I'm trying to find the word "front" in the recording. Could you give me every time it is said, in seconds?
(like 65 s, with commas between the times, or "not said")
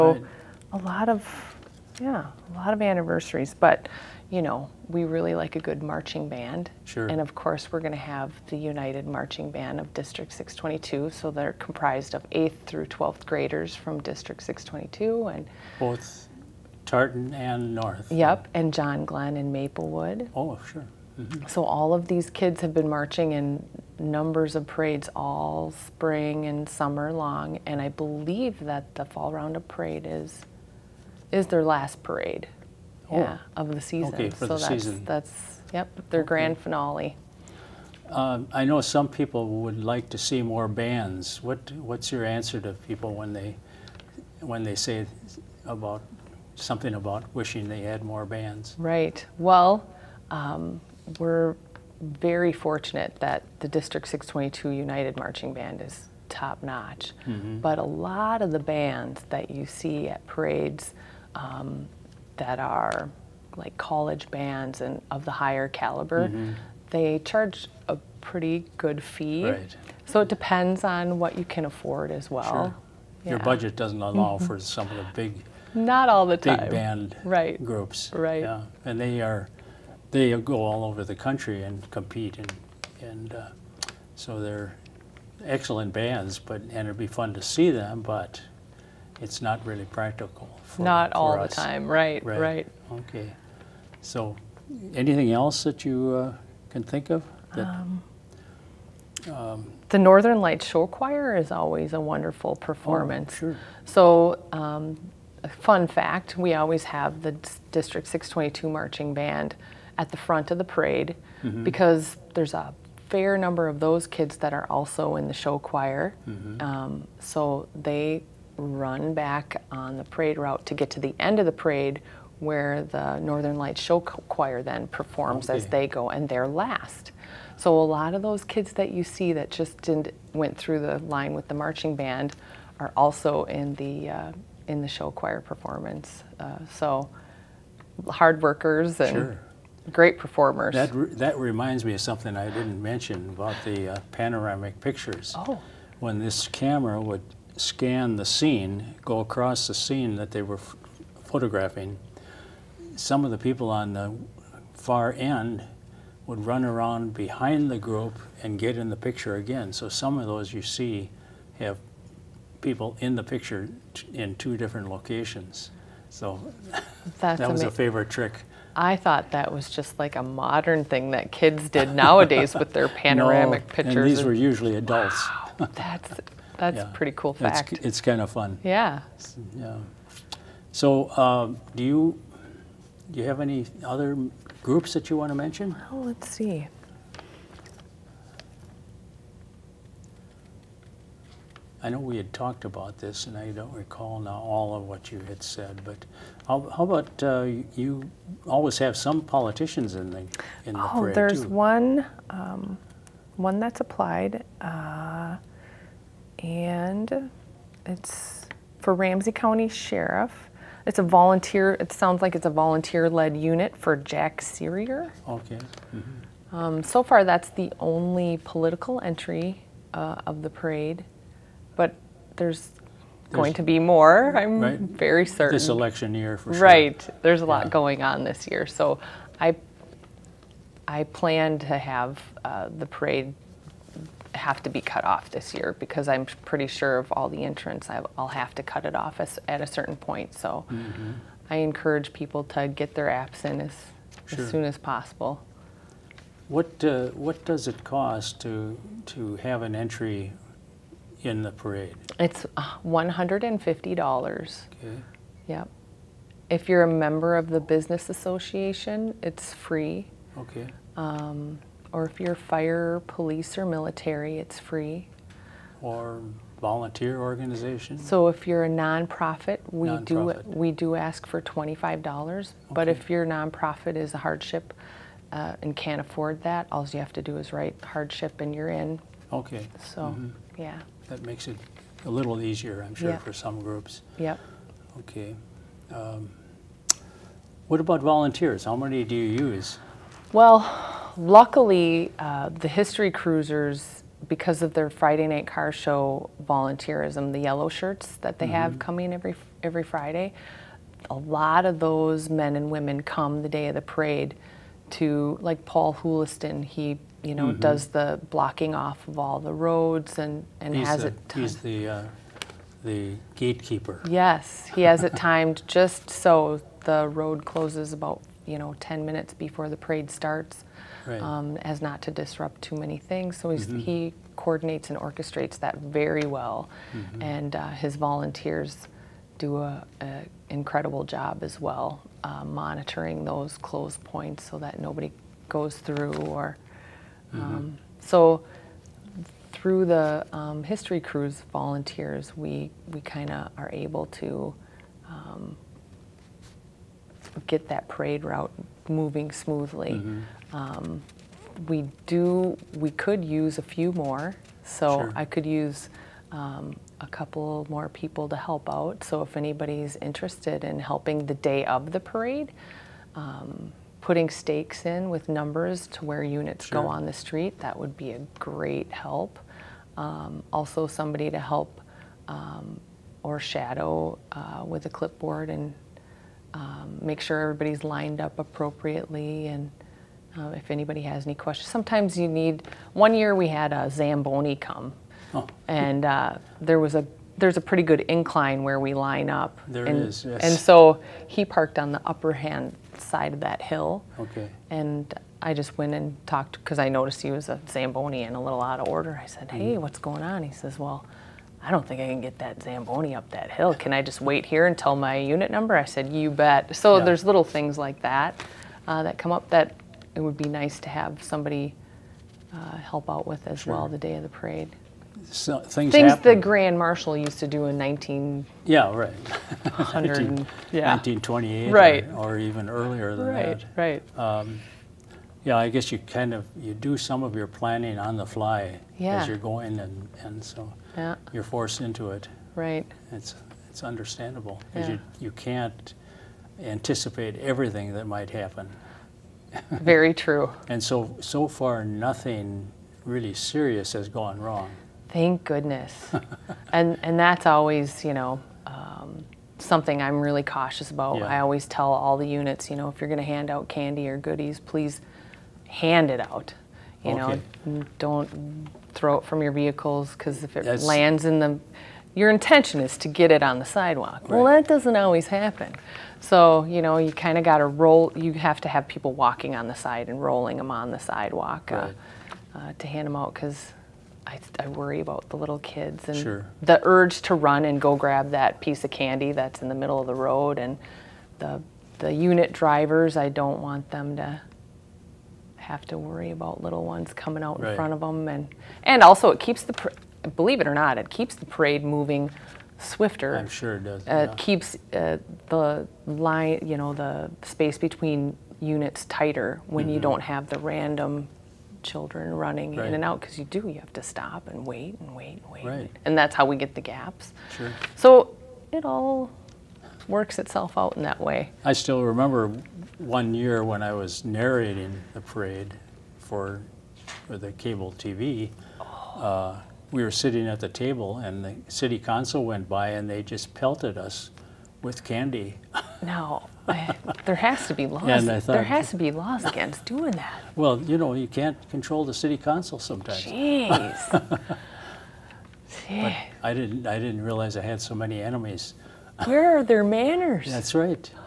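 110 s, 487 s.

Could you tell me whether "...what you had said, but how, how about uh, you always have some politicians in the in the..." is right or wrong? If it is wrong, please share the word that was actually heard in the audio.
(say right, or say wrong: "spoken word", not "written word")
right.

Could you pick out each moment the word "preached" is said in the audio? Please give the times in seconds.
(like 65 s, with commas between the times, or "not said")
not said.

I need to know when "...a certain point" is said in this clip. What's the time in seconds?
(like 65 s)
239 s.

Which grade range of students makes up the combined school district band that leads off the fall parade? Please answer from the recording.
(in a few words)
8th through 12th.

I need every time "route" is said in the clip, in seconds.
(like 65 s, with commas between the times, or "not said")
120 s, 348 s.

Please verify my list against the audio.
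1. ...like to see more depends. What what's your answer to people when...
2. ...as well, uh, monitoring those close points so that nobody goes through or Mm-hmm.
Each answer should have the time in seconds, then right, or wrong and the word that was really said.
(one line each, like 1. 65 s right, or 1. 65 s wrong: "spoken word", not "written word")
1. 39 s wrong: "bands", not "depends"
2. 331 s right.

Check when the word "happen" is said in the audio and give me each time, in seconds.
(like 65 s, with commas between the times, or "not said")
416 s, 438 s, 465 s.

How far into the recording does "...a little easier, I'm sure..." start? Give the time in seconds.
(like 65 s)
282 s.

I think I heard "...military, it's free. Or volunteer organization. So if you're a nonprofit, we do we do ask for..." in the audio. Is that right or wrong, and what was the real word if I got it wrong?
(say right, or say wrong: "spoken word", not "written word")
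right.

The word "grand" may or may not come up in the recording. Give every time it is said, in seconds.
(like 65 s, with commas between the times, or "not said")
36 s, 416 s.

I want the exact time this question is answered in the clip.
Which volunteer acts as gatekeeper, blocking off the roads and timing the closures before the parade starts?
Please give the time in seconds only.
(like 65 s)
305 s.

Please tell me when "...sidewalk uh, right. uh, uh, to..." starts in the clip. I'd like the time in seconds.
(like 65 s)
470 s.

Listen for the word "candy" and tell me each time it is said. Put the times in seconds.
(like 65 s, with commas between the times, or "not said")
453 s, 478 s, 525 s.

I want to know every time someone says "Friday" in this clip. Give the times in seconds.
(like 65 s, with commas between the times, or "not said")
294 s, 299 s.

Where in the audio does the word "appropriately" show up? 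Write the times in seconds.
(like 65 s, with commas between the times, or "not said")
378 s.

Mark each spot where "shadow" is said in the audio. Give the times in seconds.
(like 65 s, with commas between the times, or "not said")
373 s.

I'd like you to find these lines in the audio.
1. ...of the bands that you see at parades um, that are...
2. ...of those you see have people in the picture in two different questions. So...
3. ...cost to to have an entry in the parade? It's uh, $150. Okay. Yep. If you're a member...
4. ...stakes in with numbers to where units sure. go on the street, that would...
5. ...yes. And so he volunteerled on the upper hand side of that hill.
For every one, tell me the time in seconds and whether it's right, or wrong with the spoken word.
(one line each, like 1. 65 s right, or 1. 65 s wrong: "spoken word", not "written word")
1. 58 s right
2. 160 s wrong: "locations", not "questions"
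3. 247 s right
4. 364 s right
5. 390 s wrong: "parked", not "volunteerled".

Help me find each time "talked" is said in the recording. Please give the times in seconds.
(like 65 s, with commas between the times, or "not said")
192 s, 396 s.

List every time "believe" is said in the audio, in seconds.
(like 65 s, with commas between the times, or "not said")
27 s, 490 s.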